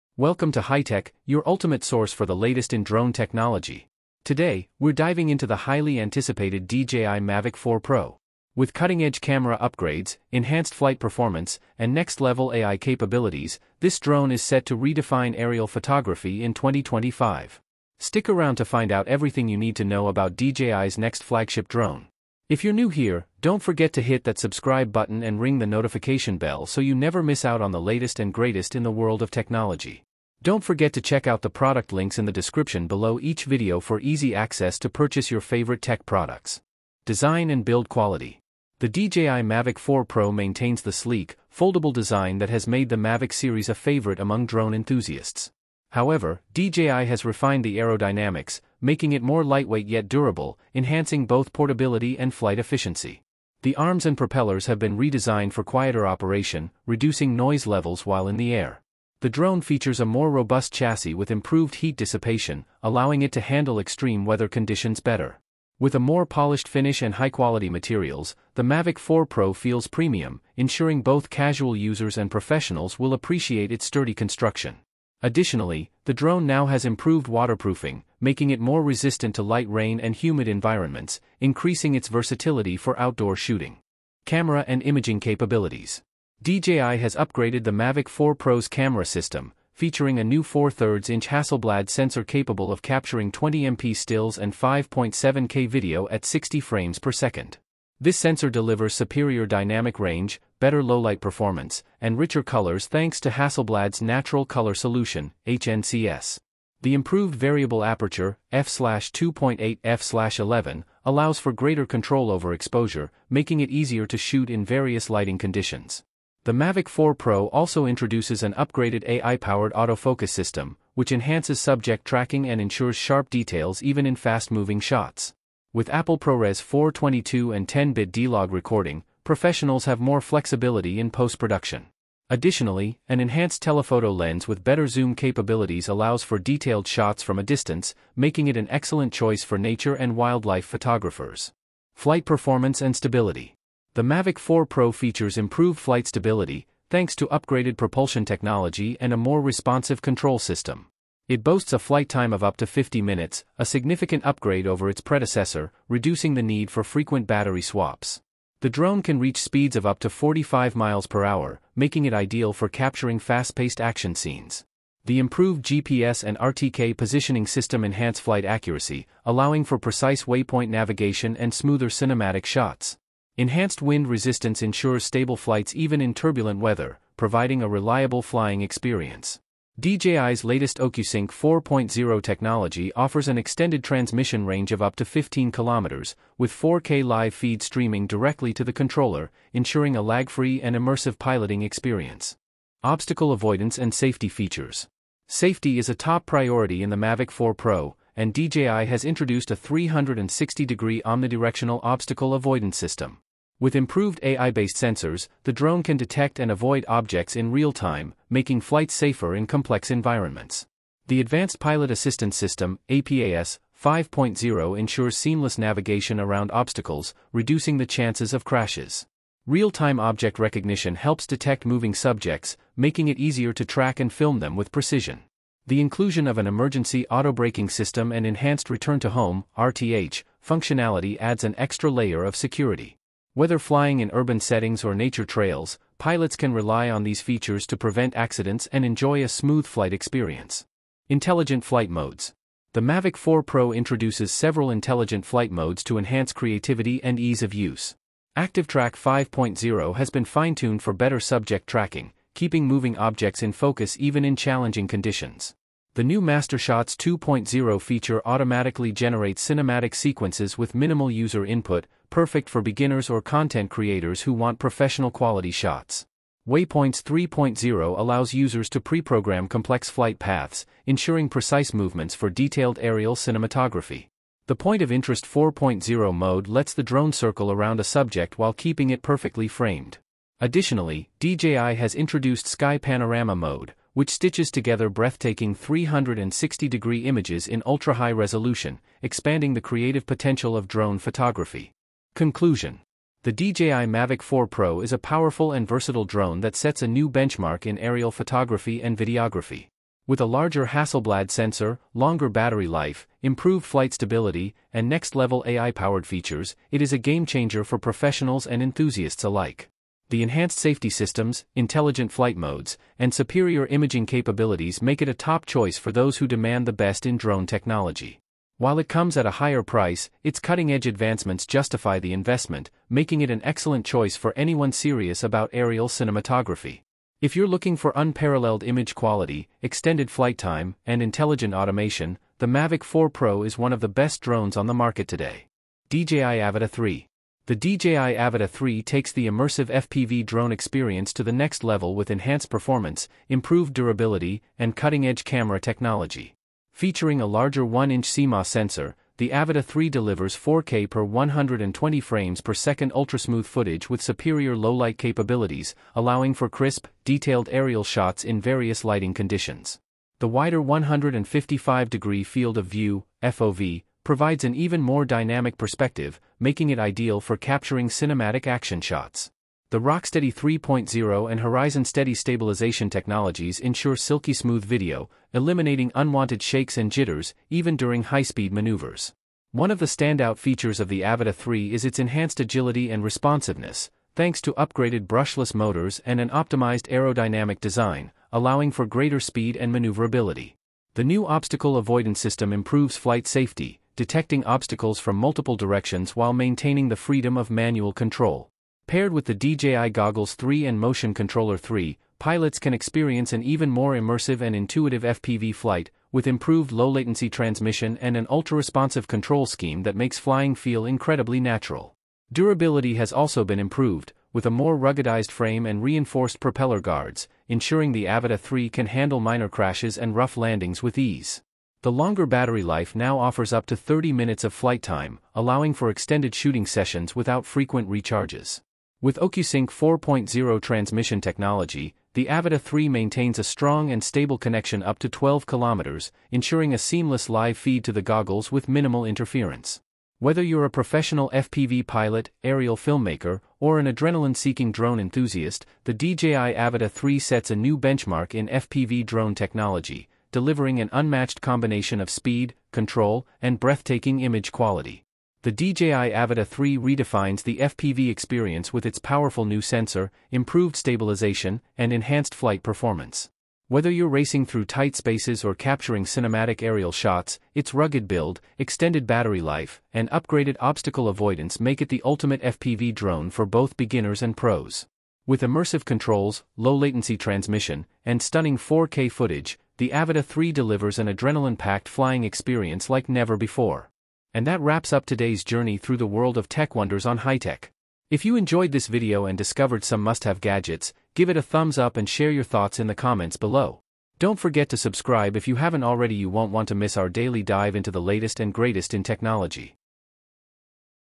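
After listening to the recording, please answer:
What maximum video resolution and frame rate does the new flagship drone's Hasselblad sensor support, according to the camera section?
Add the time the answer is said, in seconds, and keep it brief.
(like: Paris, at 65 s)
5.7K at 60 fps, at 94 s.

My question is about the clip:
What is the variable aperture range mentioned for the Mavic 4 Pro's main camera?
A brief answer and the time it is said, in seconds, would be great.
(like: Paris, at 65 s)
f2.8-f11, at 108 s.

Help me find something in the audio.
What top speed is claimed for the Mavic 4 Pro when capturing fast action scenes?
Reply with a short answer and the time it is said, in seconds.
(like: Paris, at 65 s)
45 mph, at 160 s.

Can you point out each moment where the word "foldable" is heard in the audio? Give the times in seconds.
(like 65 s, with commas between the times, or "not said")
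41 s.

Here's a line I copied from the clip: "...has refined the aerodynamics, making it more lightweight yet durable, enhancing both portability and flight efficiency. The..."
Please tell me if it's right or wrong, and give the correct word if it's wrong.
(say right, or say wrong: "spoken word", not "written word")
right.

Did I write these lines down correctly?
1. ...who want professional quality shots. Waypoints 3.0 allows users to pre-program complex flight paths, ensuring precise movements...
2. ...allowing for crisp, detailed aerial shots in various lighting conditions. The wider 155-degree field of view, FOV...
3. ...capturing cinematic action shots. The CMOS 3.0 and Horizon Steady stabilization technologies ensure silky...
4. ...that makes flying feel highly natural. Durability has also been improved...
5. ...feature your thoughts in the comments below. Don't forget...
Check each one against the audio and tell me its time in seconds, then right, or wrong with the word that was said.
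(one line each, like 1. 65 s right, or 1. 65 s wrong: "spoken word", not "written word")
1. 264 s right
2. 355 s right
3. 367 s wrong: "Rocksteady", not "CMOS"
4. 409 s wrong: "incredibly", not "highly"
5. 492 s wrong: "share", not "feature".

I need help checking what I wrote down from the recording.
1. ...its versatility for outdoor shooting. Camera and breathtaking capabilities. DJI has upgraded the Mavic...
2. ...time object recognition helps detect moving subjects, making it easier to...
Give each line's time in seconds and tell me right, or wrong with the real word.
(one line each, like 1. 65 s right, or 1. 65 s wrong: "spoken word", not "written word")
1. 81 s wrong: "imaging", not "breathtaking"
2. 219 s right.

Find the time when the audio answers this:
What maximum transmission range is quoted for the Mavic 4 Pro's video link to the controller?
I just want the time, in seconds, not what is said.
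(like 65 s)
185 s.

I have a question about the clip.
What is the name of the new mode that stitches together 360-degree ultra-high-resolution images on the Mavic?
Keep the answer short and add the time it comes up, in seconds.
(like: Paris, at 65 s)
Sky Panorama Mode, at 282 s.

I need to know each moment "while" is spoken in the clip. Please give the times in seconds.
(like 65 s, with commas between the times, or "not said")
58 s, 278 s, 318 s, 396 s.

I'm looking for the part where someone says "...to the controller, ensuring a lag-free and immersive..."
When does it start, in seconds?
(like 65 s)
188 s.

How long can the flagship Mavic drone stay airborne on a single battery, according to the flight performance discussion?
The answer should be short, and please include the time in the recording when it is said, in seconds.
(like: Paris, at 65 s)
50 minutes, at 152 s.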